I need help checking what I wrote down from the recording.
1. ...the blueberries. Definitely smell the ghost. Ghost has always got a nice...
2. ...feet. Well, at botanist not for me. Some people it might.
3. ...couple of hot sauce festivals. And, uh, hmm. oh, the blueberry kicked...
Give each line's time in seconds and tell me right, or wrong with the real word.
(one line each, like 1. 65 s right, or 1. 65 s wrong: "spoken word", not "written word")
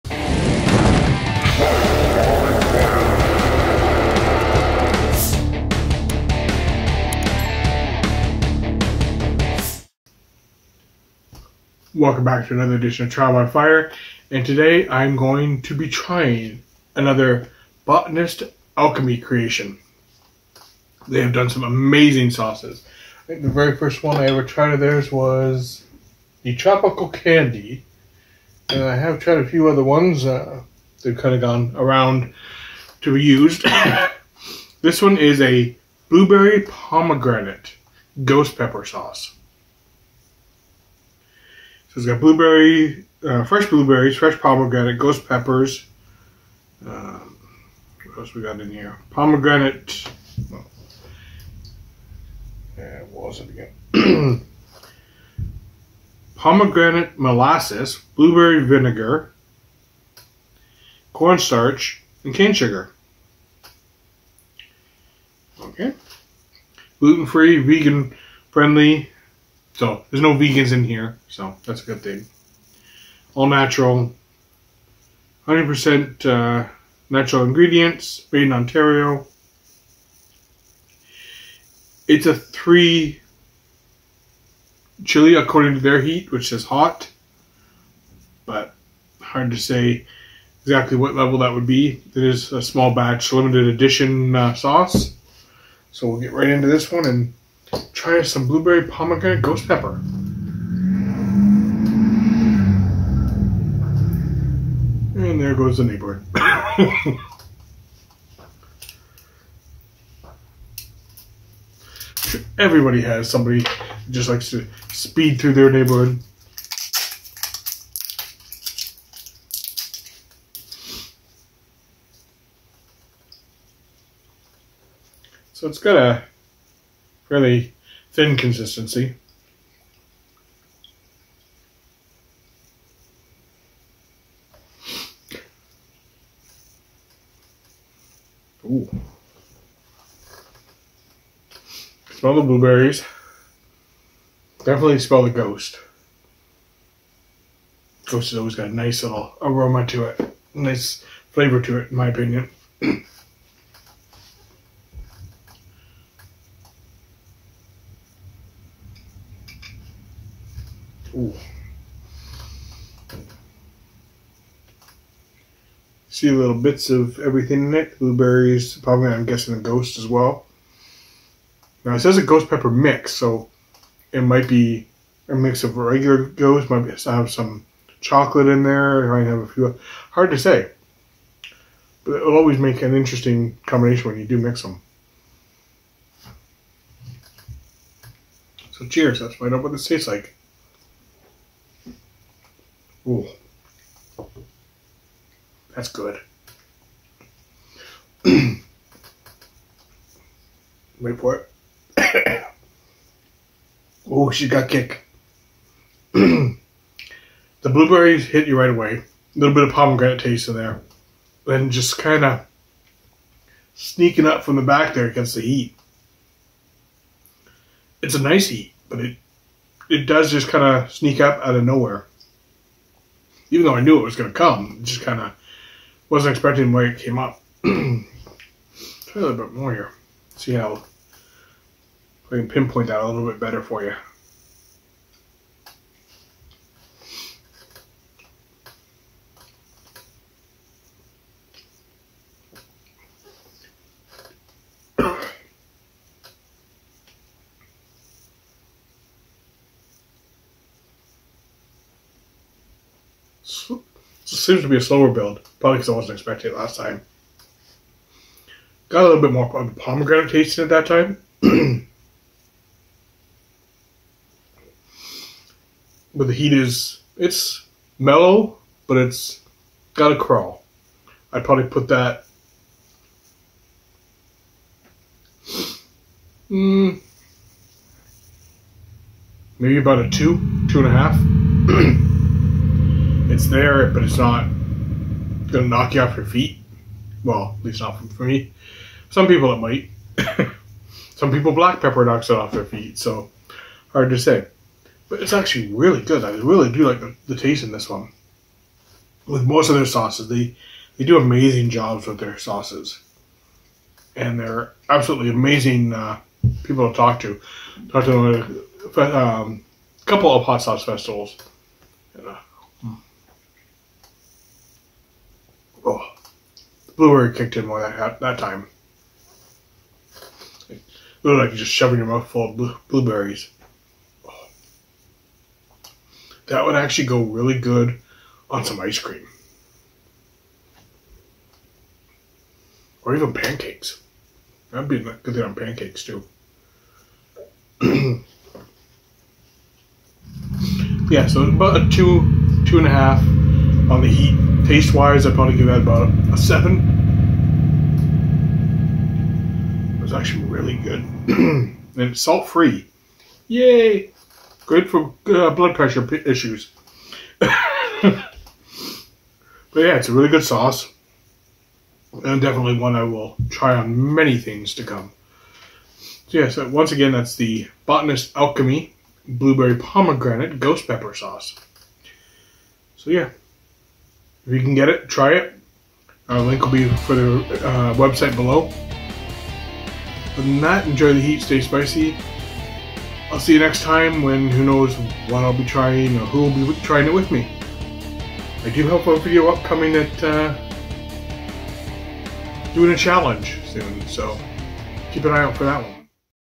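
1. 142 s right
2. 286 s wrong: "least", not "botanist"
3. 310 s right.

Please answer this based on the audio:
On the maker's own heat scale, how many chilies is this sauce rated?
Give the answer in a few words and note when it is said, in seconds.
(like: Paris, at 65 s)
3, at 82 s.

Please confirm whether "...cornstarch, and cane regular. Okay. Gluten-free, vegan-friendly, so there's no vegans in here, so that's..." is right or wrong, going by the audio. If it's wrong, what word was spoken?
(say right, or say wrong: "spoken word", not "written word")
wrong: "sugar", not "regular".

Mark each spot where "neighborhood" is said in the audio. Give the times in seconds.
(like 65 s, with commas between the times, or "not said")
105 s, 115 s.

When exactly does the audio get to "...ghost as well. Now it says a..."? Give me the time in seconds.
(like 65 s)
169 s.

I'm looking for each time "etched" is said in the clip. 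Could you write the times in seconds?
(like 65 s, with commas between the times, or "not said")
not said.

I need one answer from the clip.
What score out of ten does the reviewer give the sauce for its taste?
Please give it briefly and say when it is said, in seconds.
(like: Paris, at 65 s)
7, at 346 s.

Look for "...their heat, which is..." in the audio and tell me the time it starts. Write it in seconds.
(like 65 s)
85 s.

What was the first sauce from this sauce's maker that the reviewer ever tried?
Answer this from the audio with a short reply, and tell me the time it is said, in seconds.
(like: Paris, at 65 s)
Tropical Candy, at 26 s.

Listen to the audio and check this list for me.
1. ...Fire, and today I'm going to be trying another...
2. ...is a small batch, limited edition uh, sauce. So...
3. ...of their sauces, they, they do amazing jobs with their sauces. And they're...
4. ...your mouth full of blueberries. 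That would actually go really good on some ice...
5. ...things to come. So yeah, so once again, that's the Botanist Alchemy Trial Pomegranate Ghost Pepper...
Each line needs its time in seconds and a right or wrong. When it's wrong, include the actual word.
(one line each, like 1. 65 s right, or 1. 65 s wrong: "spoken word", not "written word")
1. 13 s right
2. 92 s right
3. 299 s right
4. 321 s right
5. 364 s wrong: "Blueberry", not "Trial".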